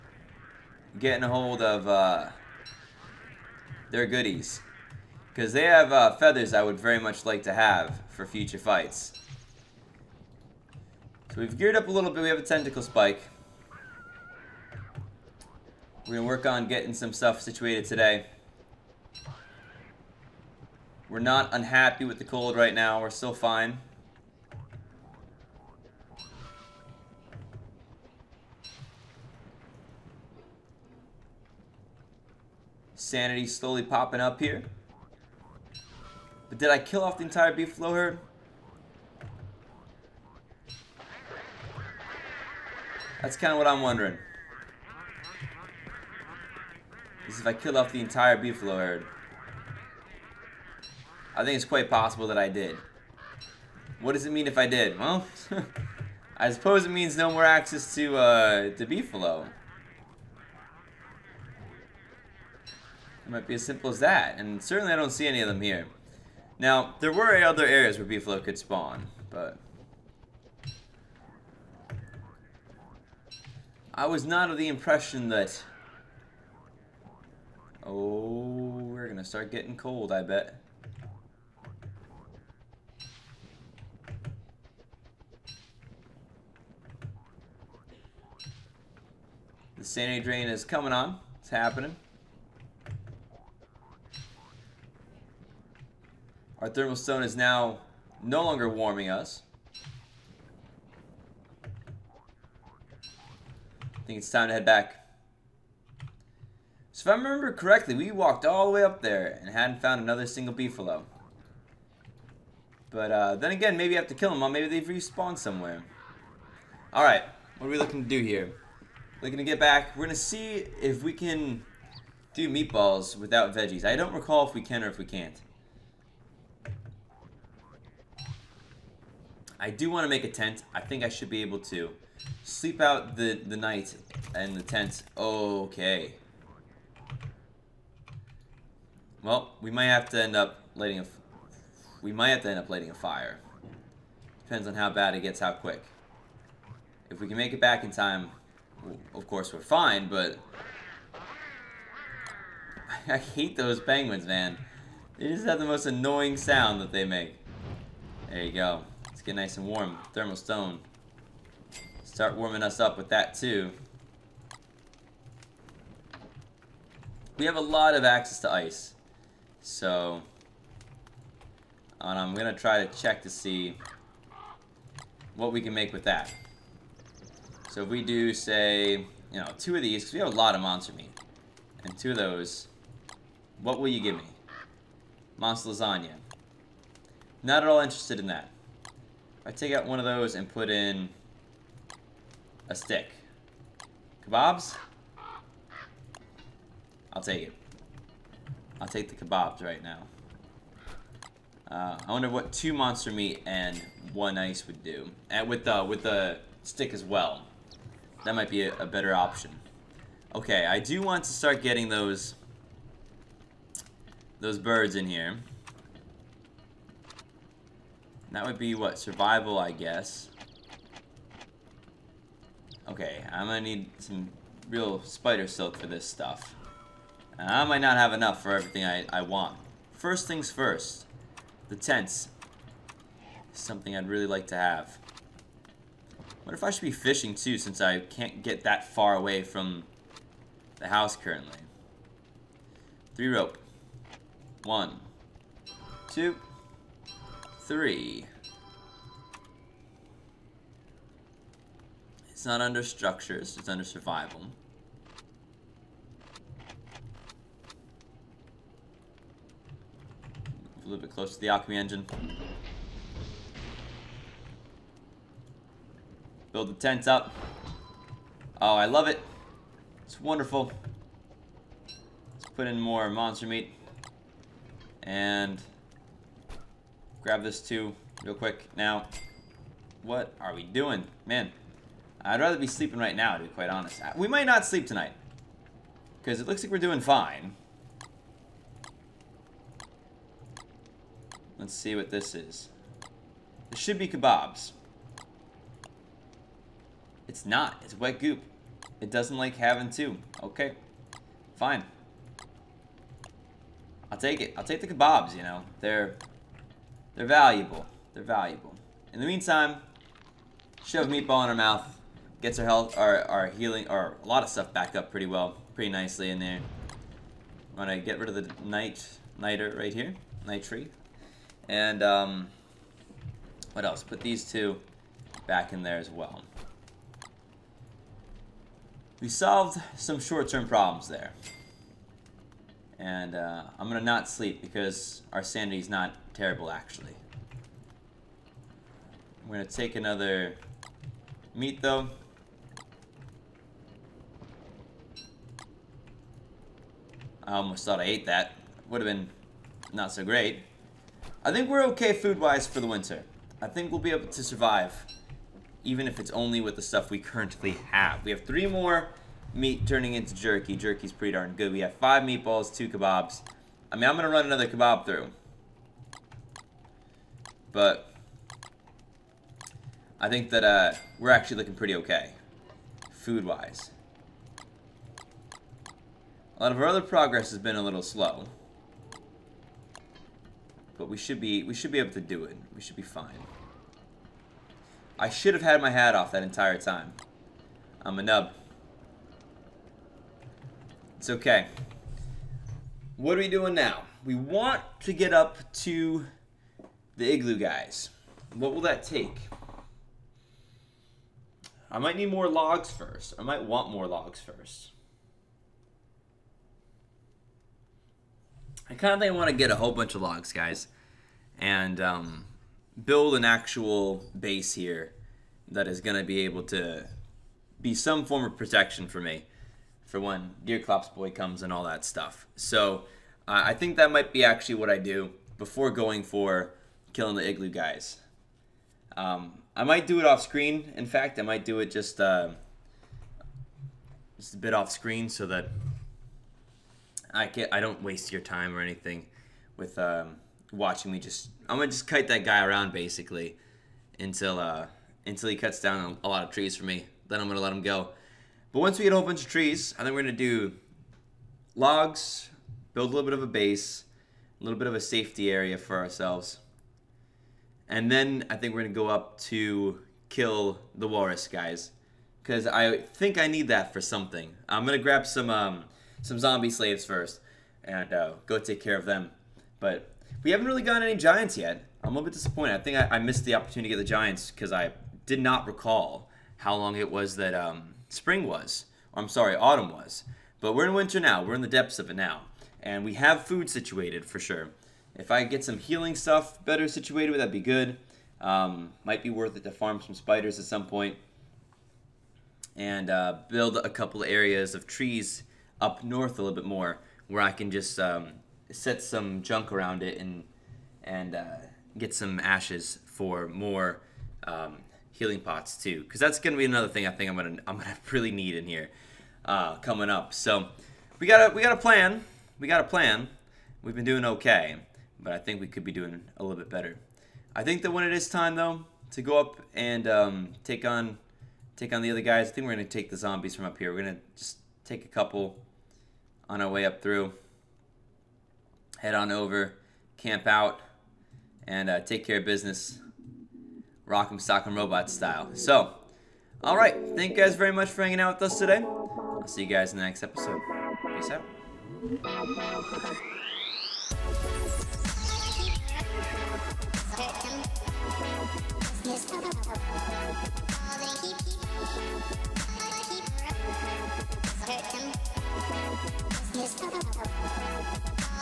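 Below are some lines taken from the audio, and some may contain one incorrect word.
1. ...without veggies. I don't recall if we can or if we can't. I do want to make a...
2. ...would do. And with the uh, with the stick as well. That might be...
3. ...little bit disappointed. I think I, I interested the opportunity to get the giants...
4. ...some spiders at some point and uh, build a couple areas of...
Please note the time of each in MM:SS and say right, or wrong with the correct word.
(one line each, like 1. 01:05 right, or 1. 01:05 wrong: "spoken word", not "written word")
1. 02:03 right
2. 03:24 right
3. 07:52 wrong: "missed", not "interested"
4. 08:09 right.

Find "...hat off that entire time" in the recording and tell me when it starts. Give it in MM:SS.
06:25.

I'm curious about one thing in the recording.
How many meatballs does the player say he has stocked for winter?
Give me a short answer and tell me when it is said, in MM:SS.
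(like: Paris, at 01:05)
5, at 06:01.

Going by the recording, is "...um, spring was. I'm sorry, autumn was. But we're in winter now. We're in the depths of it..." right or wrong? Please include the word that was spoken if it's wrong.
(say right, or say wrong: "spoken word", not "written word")
right.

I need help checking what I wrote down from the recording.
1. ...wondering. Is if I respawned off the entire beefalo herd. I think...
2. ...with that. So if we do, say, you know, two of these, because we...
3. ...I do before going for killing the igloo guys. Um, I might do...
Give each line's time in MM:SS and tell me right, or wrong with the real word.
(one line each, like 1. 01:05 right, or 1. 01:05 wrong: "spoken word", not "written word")
1. 00:43 wrong: "killed", not "respawned"
2. 02:55 right
3. 07:04 right.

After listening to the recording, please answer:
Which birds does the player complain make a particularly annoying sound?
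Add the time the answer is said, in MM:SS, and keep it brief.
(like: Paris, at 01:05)
Penguins, at 02:33.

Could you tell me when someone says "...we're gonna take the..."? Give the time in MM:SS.
08:42.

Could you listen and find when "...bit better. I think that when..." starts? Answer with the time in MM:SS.
08:36.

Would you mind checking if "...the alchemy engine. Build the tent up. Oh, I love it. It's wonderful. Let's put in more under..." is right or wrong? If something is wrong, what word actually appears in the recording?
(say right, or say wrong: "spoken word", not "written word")
wrong: "monster", not "under".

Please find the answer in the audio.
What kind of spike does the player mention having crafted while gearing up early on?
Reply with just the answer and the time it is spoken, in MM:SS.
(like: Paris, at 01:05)
Tentacle spike, at 00:12.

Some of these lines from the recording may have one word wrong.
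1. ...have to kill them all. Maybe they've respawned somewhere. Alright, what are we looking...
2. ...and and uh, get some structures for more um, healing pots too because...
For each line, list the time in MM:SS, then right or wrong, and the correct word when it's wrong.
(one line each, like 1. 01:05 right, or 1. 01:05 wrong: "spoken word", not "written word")
1. 01:53 right
2. 08:20 wrong: "ashes", not "structures".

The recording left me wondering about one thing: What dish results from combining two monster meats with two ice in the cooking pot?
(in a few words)
Monster lasagna.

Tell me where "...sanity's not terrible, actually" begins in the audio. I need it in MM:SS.
05:35.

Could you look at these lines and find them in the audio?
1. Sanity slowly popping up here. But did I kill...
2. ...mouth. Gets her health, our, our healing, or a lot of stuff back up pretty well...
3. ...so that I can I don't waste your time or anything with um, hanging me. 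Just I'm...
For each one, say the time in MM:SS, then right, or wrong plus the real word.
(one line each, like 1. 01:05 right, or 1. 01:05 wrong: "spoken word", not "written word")
1. 00:32 right
2. 05:11 right
3. 07:15 wrong: "watching", not "hanging".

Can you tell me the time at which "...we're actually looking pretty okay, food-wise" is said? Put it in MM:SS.
06:11.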